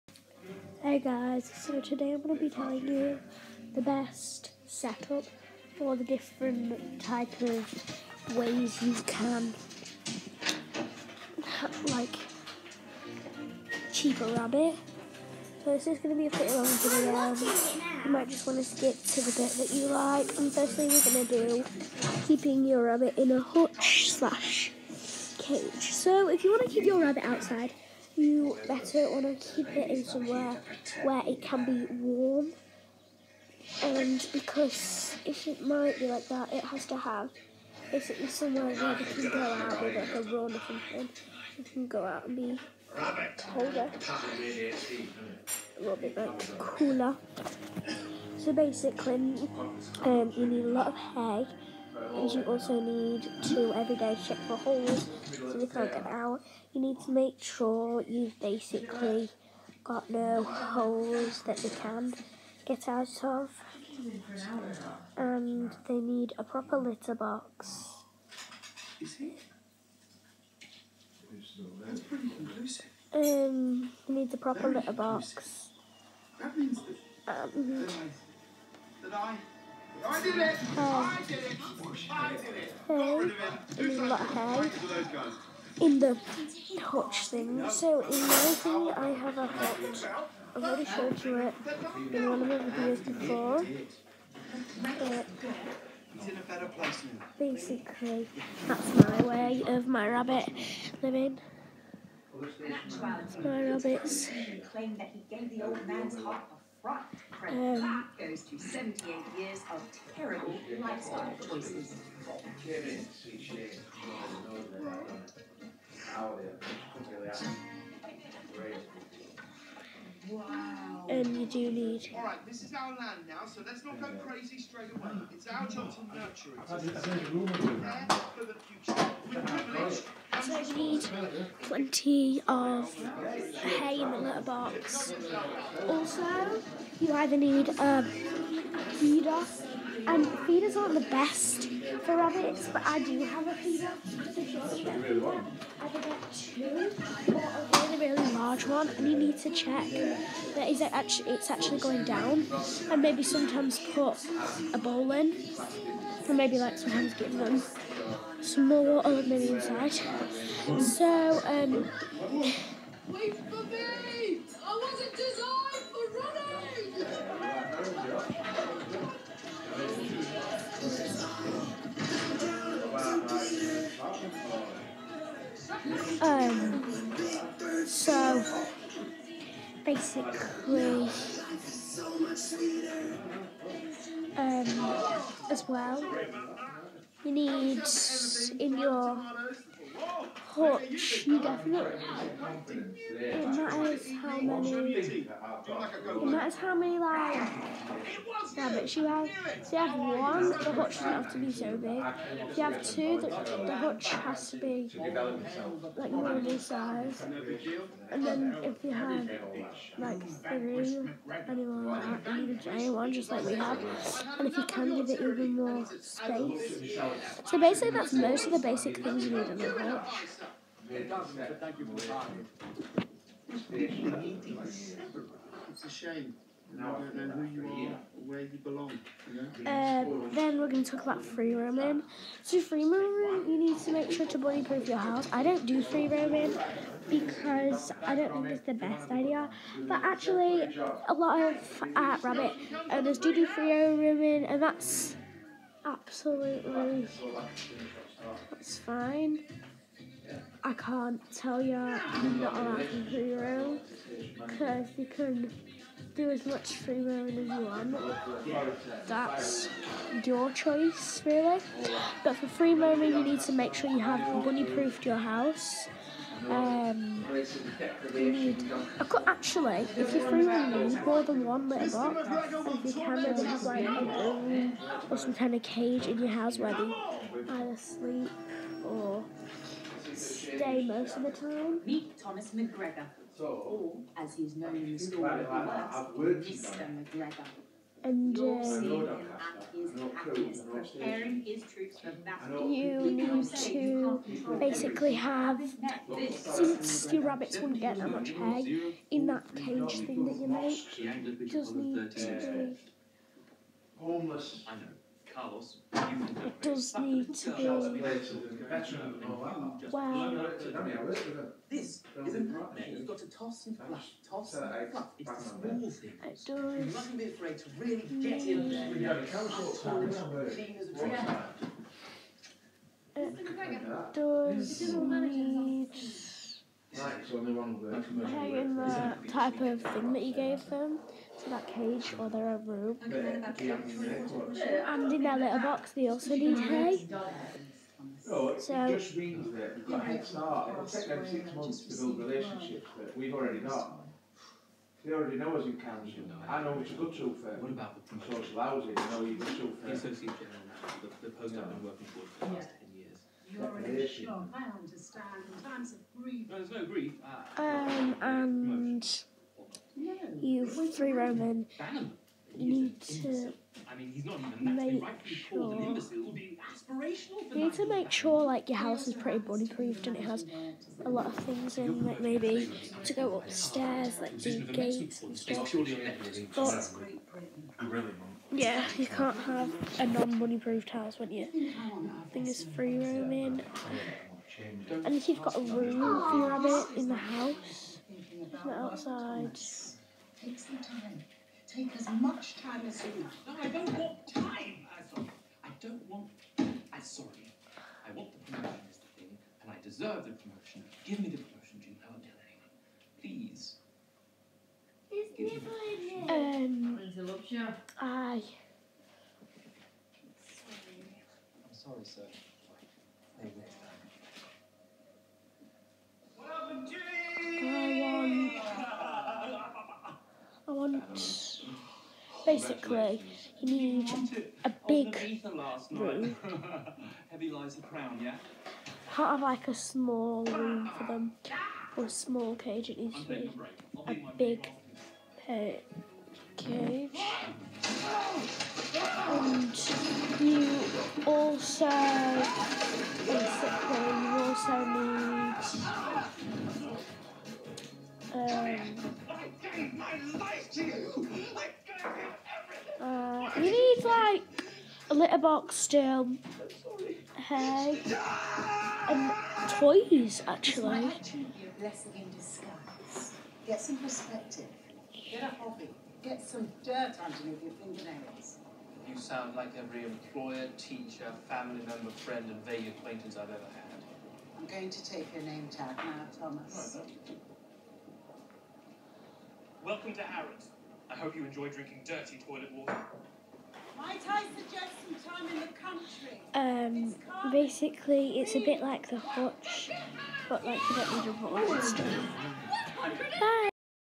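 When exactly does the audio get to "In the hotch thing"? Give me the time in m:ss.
1:25.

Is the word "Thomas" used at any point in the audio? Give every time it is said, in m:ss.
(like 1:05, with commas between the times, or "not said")
4:42, 7:56.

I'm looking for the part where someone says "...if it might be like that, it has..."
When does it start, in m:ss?
0:35.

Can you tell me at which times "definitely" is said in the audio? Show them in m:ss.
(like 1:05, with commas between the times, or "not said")
3:11.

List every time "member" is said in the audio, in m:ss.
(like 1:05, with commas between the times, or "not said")
7:51.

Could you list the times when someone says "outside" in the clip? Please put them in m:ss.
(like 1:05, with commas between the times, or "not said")
0:27, 6:28.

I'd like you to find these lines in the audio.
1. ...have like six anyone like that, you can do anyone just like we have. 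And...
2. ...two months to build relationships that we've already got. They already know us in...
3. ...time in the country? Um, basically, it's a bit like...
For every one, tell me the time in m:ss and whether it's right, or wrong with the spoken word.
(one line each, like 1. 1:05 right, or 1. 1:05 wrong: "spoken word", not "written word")
1. 3:28 wrong: "three", not "six"
2. 5:41 wrong: "six", not "two"
3. 8:05 right.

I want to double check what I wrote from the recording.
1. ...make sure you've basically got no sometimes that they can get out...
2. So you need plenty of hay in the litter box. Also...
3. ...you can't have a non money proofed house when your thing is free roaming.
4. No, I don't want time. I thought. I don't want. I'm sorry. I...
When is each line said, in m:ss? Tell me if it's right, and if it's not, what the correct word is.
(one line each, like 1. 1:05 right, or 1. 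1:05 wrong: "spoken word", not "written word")
1. 0:57 wrong: "holes", not "sometimes"
2. 2:10 right
3. 6:18 right
4. 6:33 right.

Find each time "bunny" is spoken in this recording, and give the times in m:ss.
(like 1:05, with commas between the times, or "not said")
4:24, 6:09.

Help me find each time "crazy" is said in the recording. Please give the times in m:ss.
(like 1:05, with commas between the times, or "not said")
2:04.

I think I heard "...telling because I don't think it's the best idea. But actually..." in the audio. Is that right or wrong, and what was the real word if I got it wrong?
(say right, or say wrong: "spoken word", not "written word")
wrong: "roaming", not "telling".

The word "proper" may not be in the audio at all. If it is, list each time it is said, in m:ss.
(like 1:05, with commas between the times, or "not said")
1:06, 1:14.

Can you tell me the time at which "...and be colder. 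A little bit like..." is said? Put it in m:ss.
0:42.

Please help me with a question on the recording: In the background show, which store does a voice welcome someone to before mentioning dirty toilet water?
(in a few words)
Harrods.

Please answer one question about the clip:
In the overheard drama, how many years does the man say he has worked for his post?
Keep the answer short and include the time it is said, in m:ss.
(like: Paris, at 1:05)
10, at 5:52.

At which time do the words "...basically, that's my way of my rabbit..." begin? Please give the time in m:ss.
1:37.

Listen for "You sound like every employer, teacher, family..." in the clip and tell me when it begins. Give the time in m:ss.
7:49.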